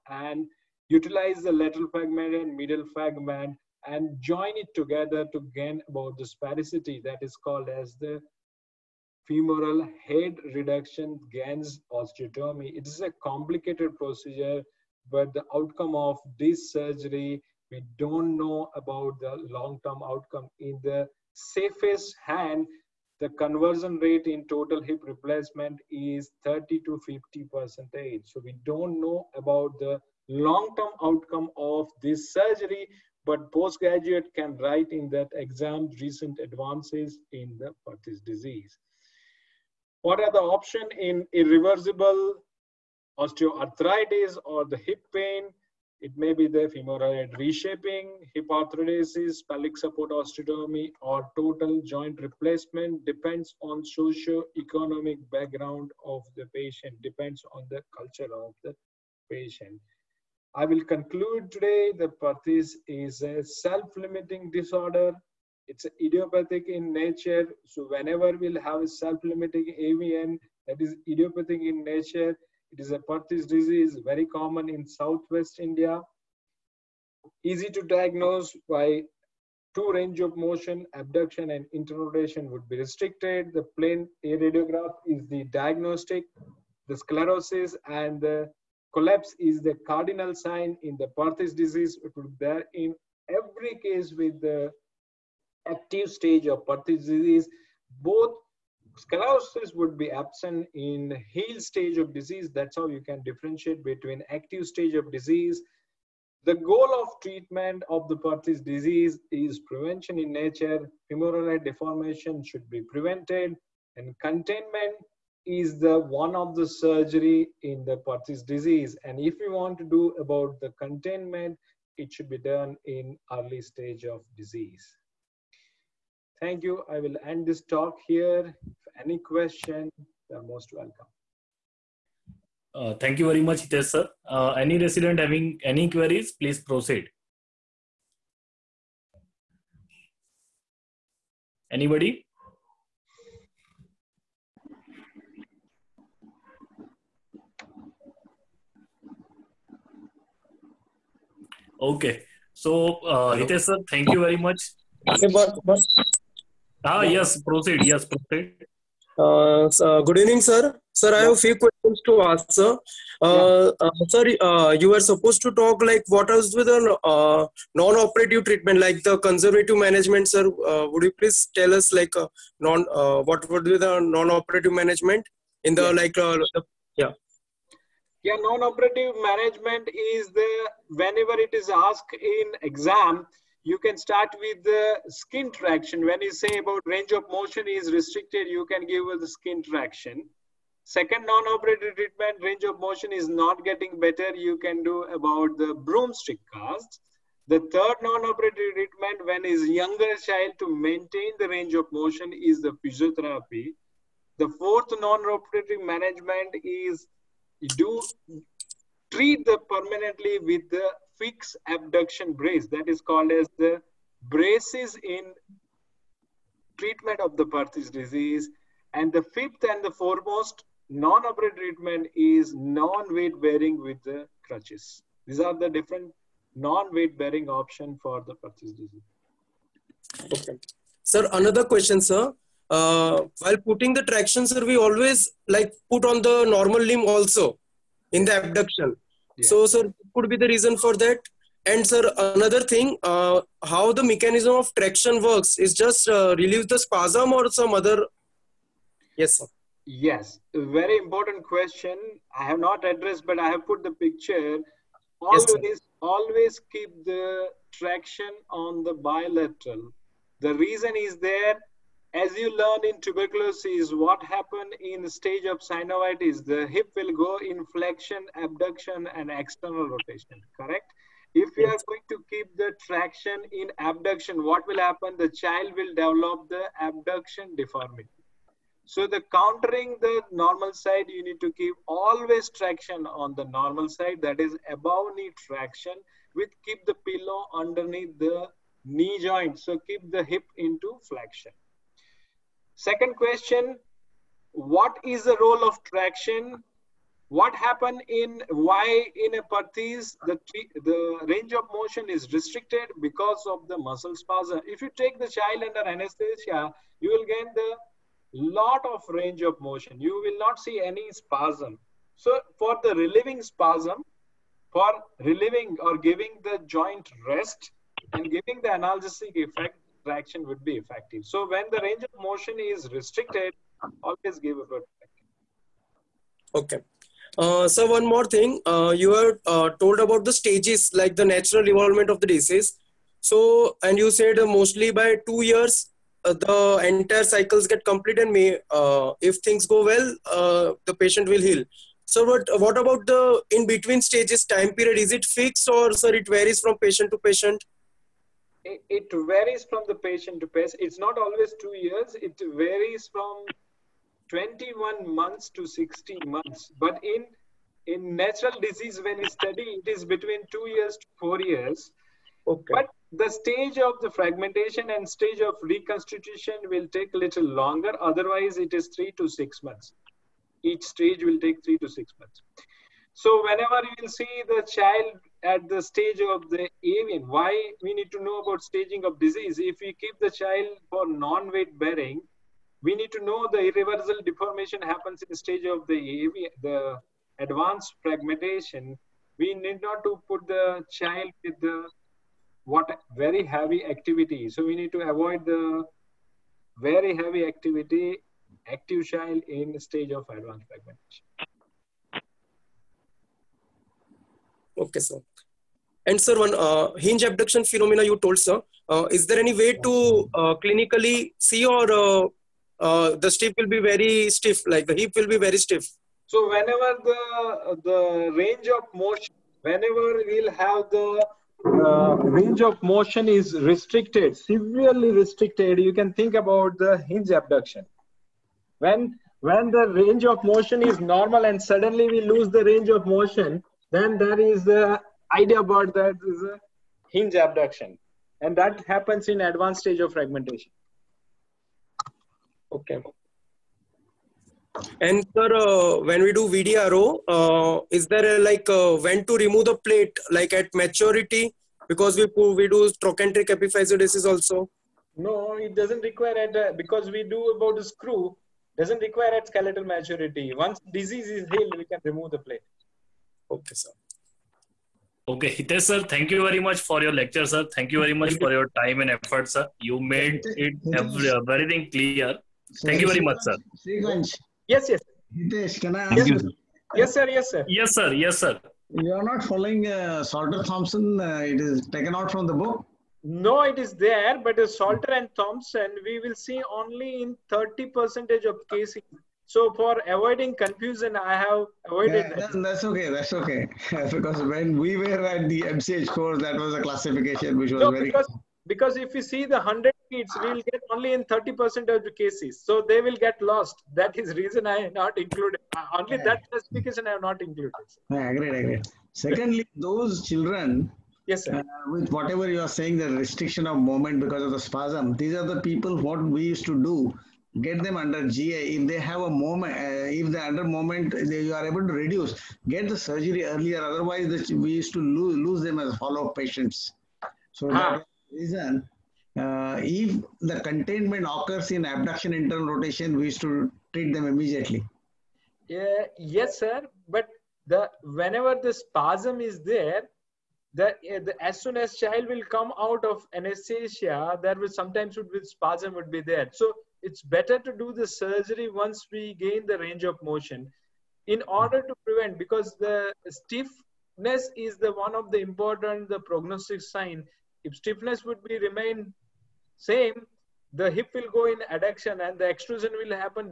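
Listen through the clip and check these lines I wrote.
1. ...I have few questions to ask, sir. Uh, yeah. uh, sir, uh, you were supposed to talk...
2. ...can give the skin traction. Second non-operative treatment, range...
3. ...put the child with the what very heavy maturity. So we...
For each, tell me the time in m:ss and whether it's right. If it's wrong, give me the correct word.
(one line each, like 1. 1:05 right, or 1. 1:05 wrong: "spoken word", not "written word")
1. 2:41 right
2. 3:08 right
3. 6:30 wrong: "activity", not "maturity".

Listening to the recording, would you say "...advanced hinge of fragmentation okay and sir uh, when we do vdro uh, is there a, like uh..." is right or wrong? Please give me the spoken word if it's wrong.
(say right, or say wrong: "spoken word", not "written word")
wrong: "stage", not "hinge".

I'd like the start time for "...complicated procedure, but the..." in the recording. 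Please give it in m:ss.
0:13.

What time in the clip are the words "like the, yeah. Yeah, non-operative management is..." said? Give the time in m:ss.
2:55.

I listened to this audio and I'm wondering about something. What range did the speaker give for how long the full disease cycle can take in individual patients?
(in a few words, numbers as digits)
21 to 60 months.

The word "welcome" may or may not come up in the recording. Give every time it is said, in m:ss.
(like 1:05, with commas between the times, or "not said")
2:10.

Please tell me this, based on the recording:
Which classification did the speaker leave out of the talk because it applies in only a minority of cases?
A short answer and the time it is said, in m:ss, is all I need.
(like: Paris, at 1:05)
Salter Thompson, at 8:00.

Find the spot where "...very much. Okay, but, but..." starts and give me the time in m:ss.
2:34.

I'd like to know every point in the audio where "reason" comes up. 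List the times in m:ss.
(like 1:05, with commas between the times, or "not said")
4:00, 4:20, 8:24, 8:48.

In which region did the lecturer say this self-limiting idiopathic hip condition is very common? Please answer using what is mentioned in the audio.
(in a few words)
Southwest India.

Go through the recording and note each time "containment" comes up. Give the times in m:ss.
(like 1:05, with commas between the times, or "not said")
1:54, 2:00, 8:50.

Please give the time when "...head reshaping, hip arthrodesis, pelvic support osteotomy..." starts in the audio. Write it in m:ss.
0:47.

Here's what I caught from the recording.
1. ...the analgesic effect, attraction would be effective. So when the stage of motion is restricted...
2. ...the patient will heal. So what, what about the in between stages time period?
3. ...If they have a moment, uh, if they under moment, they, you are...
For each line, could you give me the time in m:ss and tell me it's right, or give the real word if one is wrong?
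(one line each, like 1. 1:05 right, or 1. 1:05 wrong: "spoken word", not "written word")
1. 5:18 wrong: "range", not "stage"
2. 5:40 right
3. 8:38 right.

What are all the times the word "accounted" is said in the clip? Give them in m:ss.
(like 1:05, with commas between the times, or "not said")
not said.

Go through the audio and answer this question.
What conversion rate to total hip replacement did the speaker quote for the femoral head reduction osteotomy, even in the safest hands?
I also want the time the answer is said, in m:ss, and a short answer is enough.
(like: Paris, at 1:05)
30 to 50 percent, at 0:26.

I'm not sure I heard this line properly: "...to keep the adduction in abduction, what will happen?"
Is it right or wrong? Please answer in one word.
wrong.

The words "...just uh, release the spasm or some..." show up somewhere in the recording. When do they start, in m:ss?
4:05.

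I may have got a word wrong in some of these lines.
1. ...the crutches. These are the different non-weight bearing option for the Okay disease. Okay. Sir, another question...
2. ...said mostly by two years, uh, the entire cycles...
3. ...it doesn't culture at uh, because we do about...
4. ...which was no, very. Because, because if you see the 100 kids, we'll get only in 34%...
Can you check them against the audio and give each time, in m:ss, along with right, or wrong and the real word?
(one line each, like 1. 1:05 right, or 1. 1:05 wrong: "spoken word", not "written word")
1. 3:44 wrong: "Perthes", not "Okay"
2. 5:34 right
3. 7:35 wrong: "require", not "culture"
4. 8:17 wrong: "30", not "34".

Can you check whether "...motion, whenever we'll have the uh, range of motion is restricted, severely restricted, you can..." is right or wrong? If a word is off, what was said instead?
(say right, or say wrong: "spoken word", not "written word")
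right.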